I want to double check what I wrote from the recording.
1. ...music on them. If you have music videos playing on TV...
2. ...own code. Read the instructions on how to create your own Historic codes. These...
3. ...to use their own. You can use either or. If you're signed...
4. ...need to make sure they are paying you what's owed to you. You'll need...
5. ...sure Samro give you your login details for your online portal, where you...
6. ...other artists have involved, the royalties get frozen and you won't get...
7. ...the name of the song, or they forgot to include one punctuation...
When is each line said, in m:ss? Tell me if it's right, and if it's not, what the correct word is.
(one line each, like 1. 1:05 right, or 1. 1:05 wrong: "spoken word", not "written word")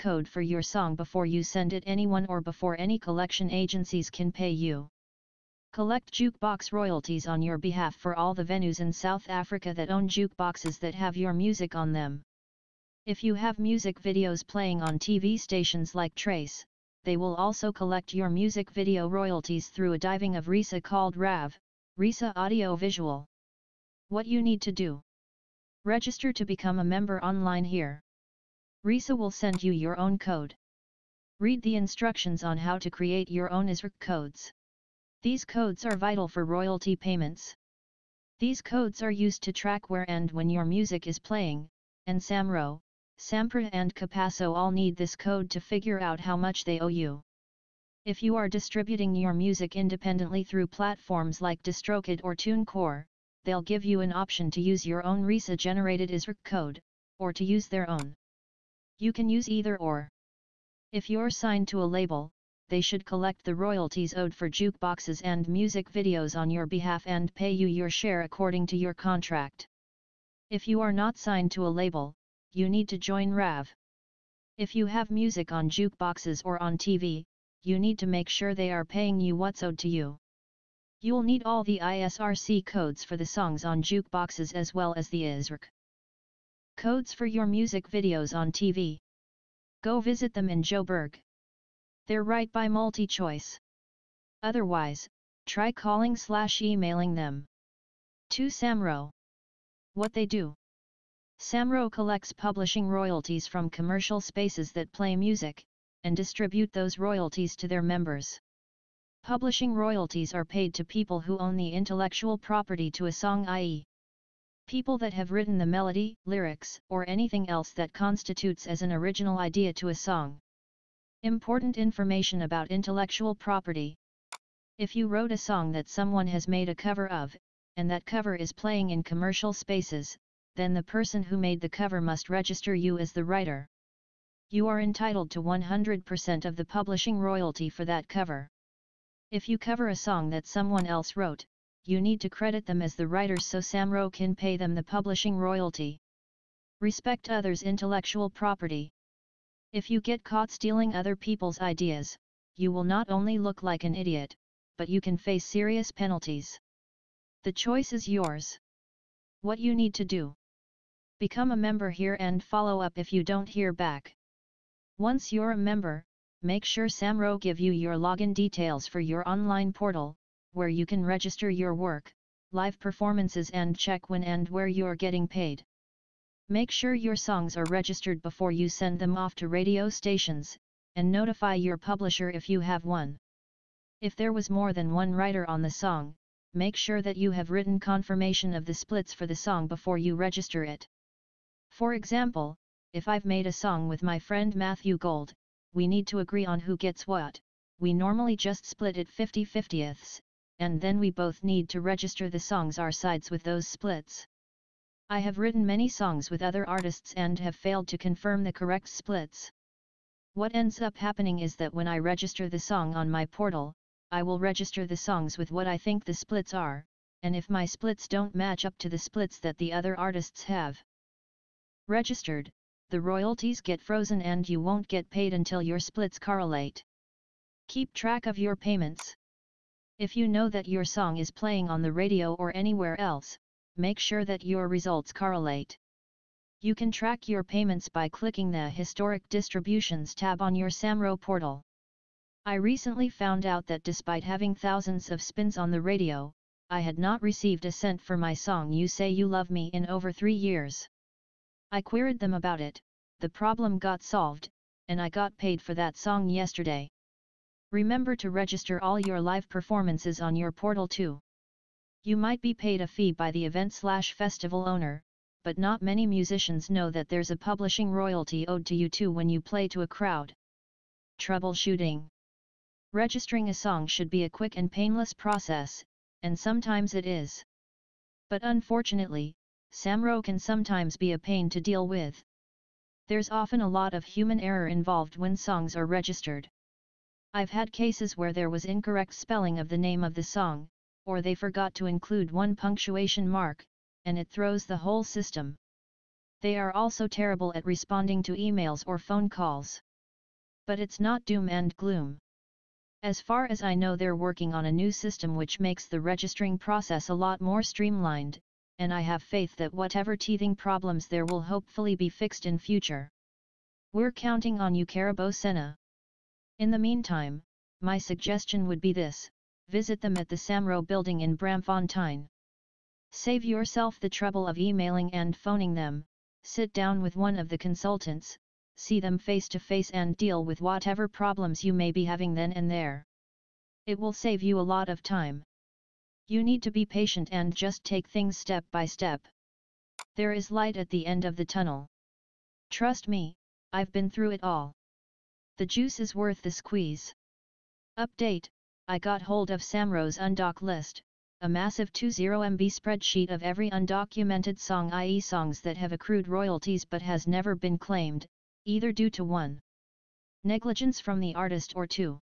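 1. 0:11 right
2. 0:29 wrong: "ISRC", not "Historic"
3. 0:57 right
4. 1:17 right
5. 2:46 right
6. 3:39 wrong: "registered", not "involved"
7. 4:49 right.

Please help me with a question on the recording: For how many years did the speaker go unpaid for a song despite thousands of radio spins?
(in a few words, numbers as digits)
3.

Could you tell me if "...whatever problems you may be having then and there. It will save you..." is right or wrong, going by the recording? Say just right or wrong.
right.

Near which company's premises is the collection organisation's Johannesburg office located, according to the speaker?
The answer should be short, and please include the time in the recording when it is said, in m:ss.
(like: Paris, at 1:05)
MultiChoice, at 1:32.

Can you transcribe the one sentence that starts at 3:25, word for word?
I have written many songs with other artists and have failed to confirm the correct splits.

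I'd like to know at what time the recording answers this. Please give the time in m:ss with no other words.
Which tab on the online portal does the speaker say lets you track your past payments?
3:58.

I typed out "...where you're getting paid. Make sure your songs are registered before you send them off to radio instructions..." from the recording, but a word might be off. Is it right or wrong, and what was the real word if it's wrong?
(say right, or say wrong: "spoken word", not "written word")
wrong: "stations", not "instructions".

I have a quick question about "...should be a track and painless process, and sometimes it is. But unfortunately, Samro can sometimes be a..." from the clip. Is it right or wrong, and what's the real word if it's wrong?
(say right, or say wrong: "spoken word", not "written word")
wrong: "quick", not "track".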